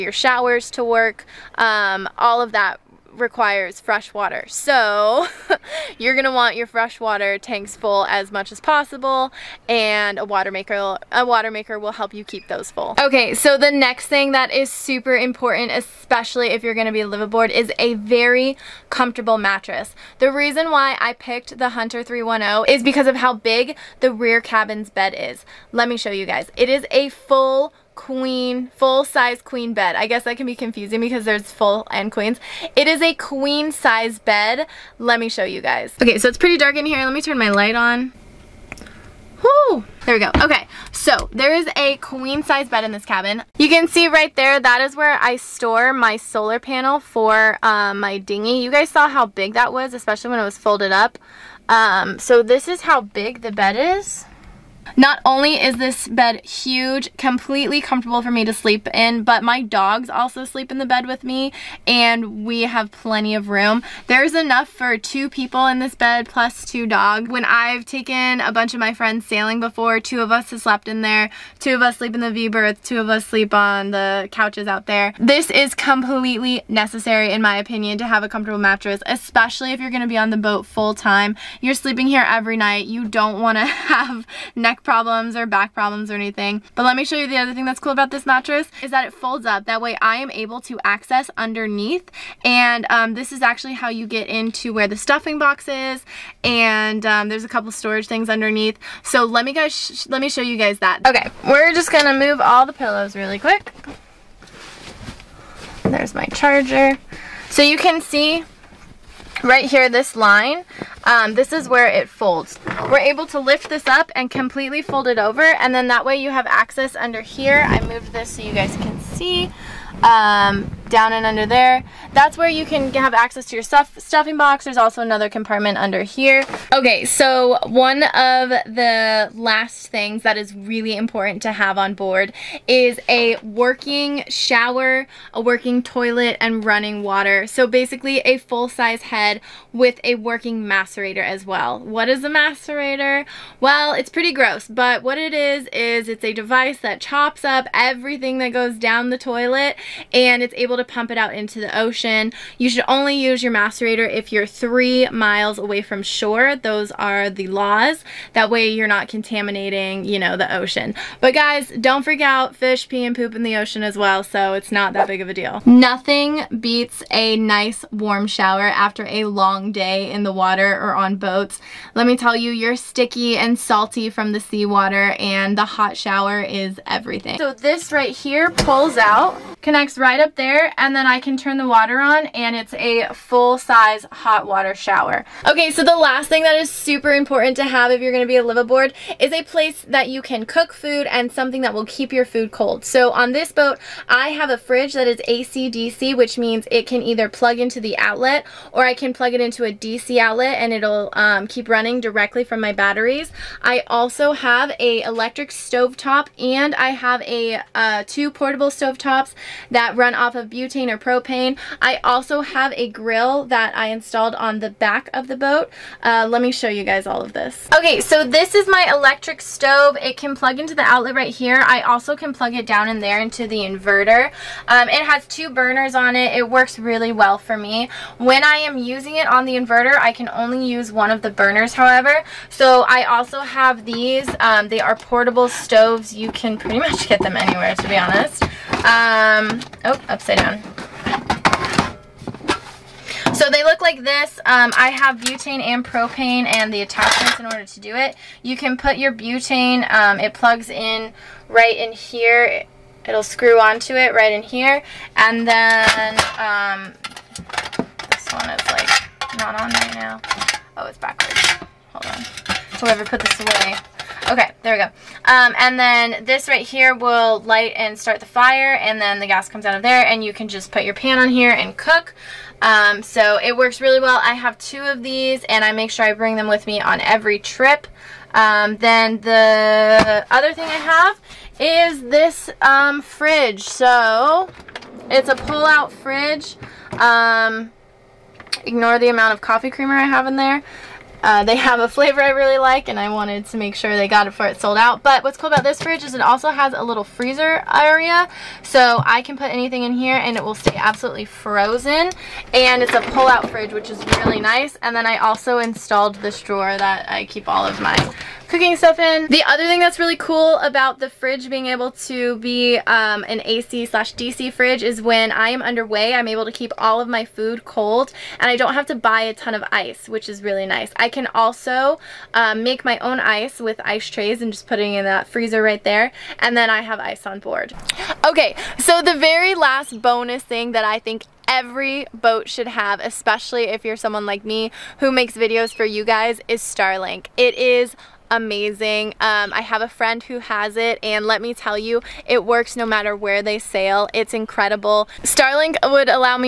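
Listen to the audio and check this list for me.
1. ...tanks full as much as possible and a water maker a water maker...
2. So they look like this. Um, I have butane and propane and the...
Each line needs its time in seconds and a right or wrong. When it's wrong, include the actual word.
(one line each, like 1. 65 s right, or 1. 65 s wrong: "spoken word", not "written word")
1. 7 s right
2. 243 s right.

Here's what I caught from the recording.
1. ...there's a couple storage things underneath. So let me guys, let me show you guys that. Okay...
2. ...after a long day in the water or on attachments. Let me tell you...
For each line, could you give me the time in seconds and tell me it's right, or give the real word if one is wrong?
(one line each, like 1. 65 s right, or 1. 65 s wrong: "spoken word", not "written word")
1. 97 s right
2. 168 s wrong: "boats", not "attachments".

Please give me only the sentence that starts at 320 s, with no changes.
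I can also um, make my own ice with ice trays and just putting in that freezer right there.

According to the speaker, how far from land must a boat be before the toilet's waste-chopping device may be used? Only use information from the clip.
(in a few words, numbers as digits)
3 miles.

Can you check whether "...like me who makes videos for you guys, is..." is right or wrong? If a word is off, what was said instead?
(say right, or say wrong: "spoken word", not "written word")
right.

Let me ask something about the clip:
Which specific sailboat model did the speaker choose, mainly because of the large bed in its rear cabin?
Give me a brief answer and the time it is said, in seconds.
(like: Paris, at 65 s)
Hunter 310, at 21 s.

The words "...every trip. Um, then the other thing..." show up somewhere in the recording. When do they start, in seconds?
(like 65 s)
277 s.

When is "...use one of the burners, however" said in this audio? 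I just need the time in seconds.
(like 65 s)
230 s.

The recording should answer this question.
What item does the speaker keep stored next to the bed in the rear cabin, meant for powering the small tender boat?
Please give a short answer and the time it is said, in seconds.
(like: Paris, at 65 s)
solar panel, at 46 s.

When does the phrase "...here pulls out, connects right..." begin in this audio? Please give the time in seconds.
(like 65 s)
178 s.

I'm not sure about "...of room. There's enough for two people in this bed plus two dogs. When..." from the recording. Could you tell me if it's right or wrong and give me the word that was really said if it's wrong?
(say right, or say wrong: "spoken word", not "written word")
right.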